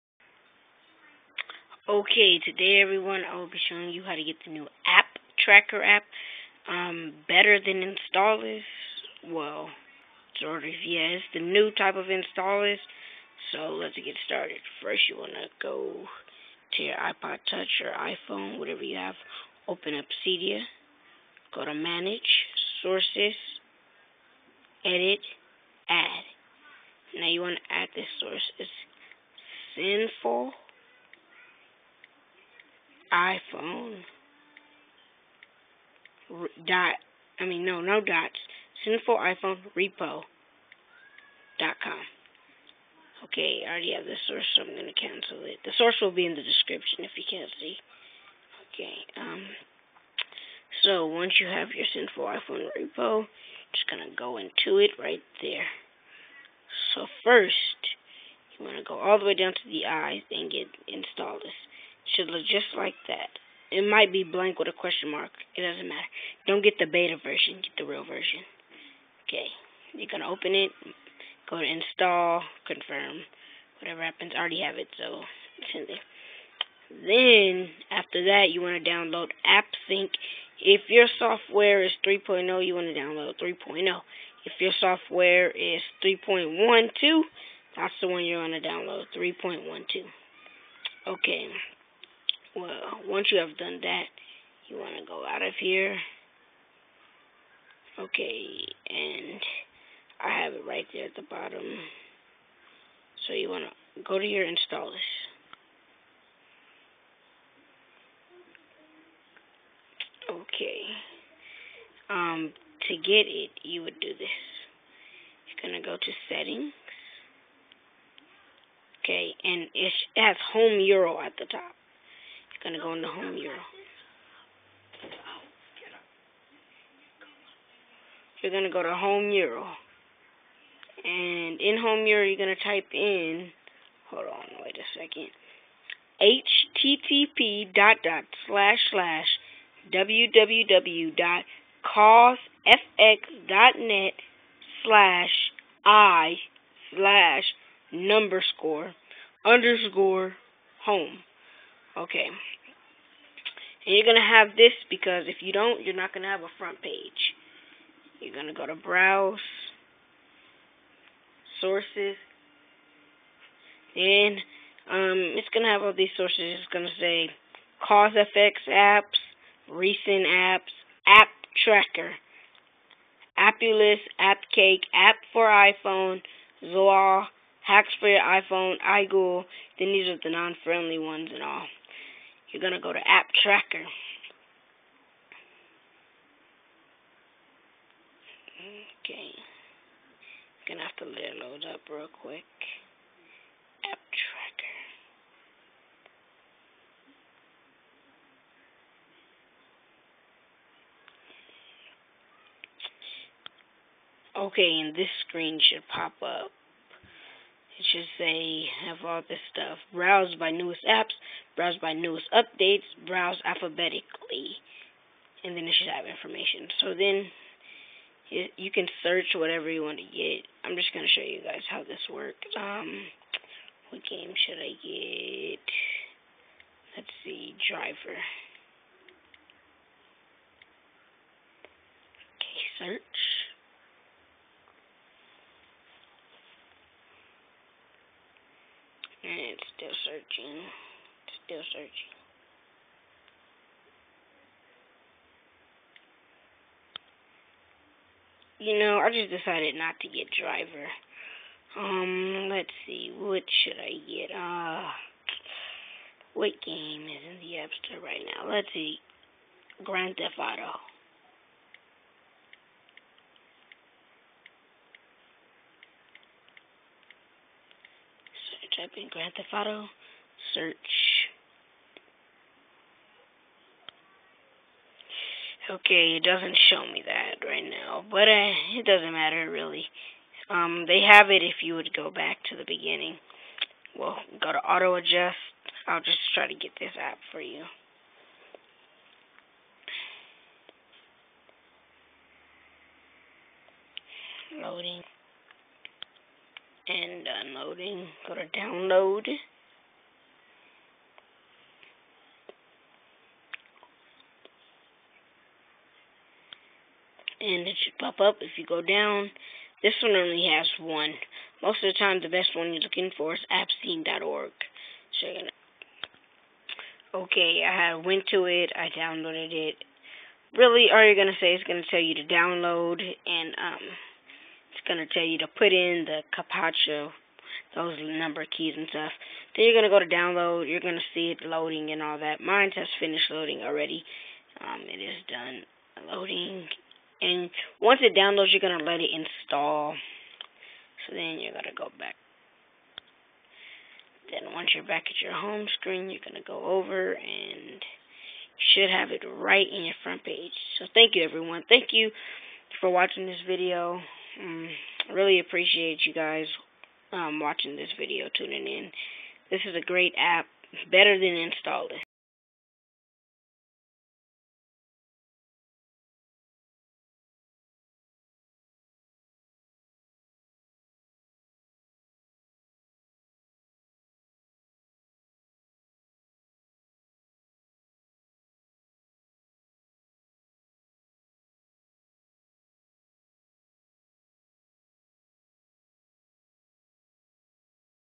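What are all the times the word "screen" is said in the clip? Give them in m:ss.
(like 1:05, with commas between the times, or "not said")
3:25, 5:45.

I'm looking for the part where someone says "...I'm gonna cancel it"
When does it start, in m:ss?
0:44.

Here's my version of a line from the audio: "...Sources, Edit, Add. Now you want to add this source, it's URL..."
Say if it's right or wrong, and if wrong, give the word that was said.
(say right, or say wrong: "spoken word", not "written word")
wrong: "Sinful", not "URL".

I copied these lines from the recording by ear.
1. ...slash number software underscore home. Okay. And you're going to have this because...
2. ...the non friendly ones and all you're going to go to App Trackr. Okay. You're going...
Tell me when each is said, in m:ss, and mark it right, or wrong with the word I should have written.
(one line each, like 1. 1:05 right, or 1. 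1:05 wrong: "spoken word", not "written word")
1. 2:26 wrong: "score", not "software"
2. 3:00 right.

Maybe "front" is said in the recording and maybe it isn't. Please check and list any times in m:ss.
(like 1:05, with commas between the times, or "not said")
2:36, 5:50.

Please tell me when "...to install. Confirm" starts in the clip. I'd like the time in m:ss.
1:11.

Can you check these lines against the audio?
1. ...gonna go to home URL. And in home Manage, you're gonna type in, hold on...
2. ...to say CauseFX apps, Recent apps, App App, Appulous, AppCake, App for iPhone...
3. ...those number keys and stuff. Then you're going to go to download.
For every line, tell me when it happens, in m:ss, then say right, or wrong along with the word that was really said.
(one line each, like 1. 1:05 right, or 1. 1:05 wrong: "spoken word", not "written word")
1. 2:08 wrong: "URL", not "Manage"
2. 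2:46 wrong: "Trackr", not "App"
3. 5:27 right.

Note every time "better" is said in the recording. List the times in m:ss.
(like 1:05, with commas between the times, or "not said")
0:07, 6:00.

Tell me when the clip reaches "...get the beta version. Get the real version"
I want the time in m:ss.
1:06.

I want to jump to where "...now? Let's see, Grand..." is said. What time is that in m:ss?
4:18.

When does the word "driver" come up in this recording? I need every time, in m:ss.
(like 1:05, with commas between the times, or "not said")
3:47, 4:10.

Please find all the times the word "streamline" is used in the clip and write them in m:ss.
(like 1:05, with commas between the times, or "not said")
not said.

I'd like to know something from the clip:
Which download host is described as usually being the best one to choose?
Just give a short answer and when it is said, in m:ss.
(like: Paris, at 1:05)
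appscene.org, at 5:13.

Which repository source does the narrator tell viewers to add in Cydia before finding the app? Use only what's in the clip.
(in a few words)
Sinful iPhone repo dot com.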